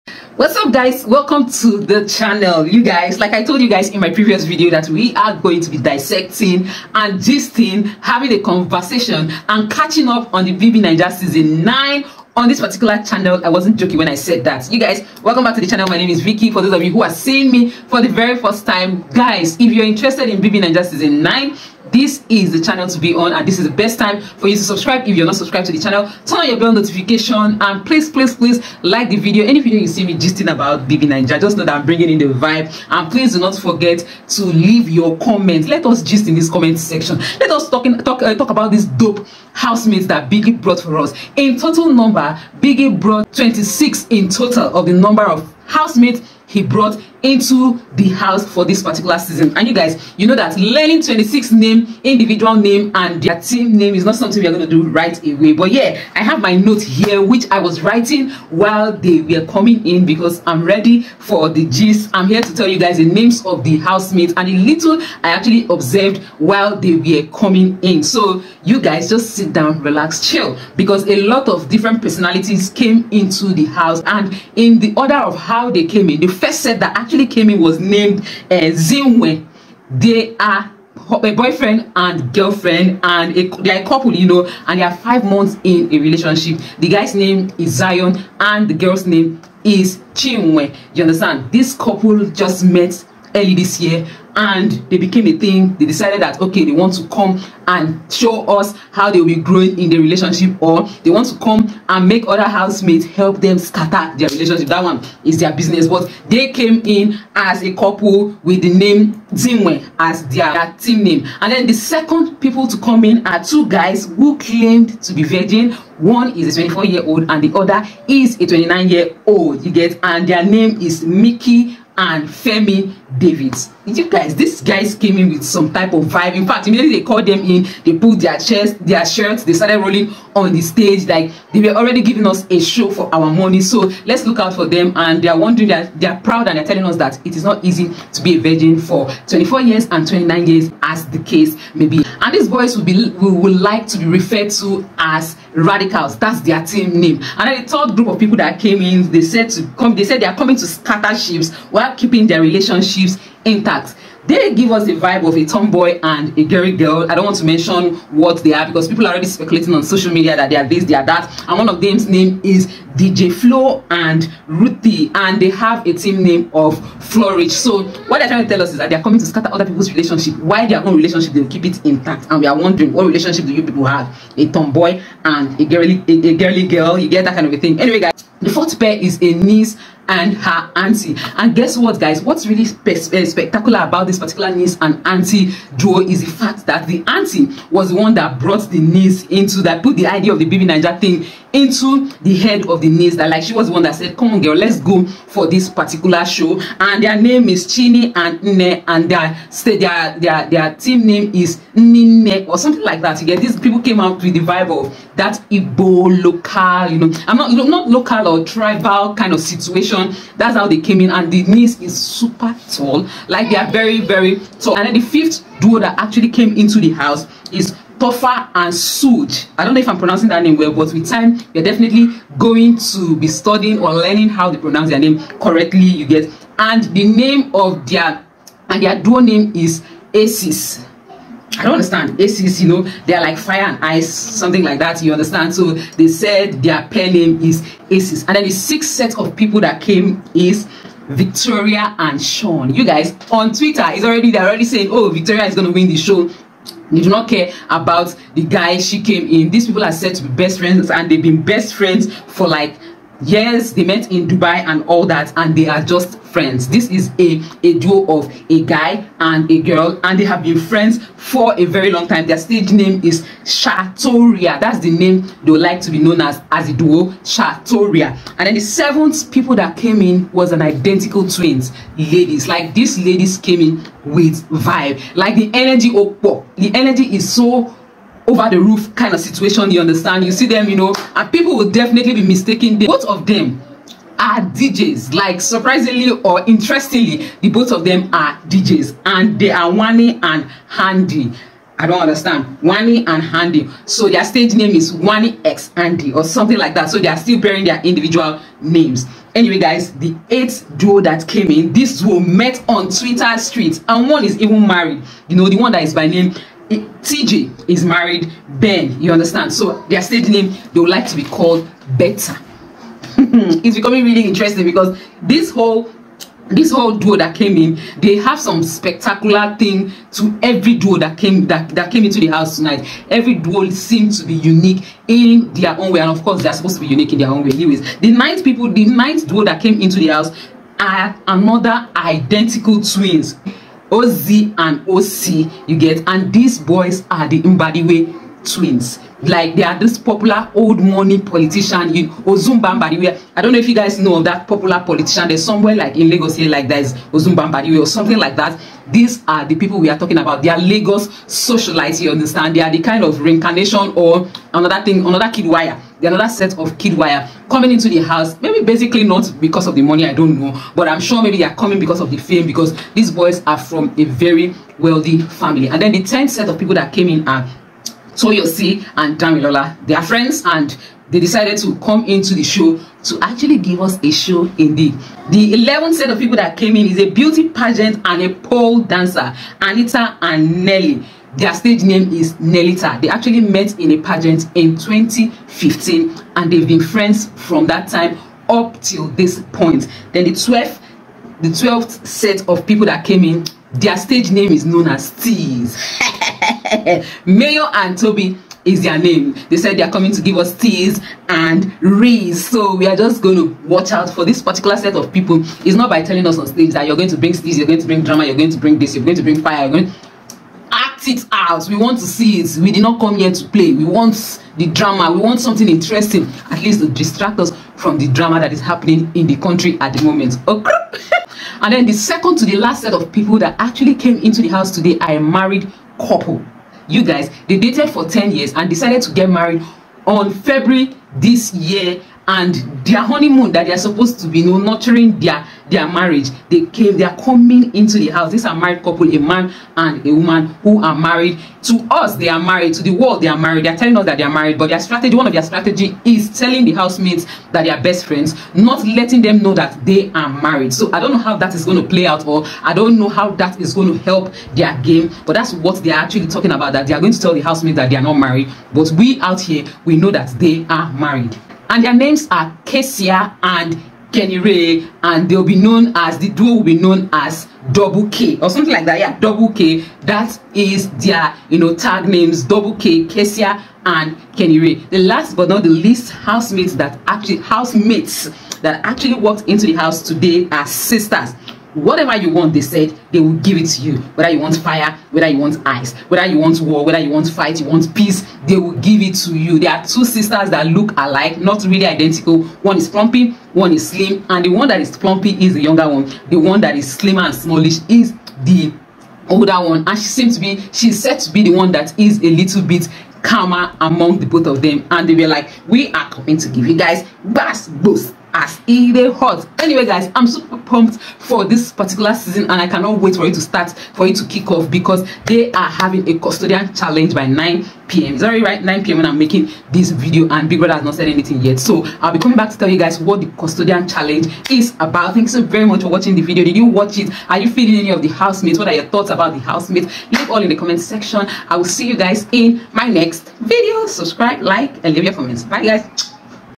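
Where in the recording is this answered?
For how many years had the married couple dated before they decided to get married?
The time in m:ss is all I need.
7:08.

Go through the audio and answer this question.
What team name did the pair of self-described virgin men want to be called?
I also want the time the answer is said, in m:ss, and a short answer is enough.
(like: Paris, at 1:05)
Radicals, at 2:25.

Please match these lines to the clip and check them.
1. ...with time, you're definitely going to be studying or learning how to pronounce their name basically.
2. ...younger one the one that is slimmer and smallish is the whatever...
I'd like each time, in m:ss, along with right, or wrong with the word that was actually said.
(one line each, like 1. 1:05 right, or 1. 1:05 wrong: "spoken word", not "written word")
1. 3:40 wrong: "correctly", not "basically"
2. 8:15 wrong: "older", not "whatever".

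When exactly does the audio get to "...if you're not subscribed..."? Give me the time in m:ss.
0:25.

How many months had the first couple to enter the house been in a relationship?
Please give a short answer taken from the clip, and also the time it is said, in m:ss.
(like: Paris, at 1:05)
5, at 1:24.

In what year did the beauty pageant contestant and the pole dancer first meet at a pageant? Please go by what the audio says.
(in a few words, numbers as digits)
2015.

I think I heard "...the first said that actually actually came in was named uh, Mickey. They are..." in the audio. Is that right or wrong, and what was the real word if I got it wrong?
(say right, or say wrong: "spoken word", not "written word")
wrong: "Zinwe", not "Mickey".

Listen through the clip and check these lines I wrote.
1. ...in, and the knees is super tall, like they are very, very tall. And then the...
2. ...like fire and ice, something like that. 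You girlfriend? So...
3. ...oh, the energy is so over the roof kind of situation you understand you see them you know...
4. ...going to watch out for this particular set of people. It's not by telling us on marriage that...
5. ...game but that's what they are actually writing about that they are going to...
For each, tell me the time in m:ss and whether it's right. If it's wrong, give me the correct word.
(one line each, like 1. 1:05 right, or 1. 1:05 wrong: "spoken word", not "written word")
1. 3:31 right
2. 3:53 wrong: "understand", not "girlfriend"
3. 4:36 right
4. 6:43 wrong: "stage", not "marriage"
5. 7:34 wrong: "talking", not "writing".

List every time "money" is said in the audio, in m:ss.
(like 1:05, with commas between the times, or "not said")
2:13, 5:40, 5:59.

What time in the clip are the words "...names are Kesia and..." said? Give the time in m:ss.
7:41.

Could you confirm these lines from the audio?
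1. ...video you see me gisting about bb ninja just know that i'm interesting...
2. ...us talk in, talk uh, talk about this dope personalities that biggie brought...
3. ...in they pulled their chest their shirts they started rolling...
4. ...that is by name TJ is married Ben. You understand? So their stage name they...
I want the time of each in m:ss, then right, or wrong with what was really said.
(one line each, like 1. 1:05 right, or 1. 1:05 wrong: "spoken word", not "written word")
1. 0:29 wrong: "bringing", not "interesting"
2. 0:37 wrong: "housemates", not "personalities"
3. 2:07 right
4. 5:05 right.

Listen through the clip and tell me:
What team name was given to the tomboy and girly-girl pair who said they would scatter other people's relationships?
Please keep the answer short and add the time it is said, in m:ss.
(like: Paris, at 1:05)
Flourish, at 2:47.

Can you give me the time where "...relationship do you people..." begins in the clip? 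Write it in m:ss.
2:53.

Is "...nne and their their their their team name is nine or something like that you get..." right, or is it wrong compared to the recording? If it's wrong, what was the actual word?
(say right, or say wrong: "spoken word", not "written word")
right.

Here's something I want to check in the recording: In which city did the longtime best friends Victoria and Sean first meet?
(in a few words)
Dubai.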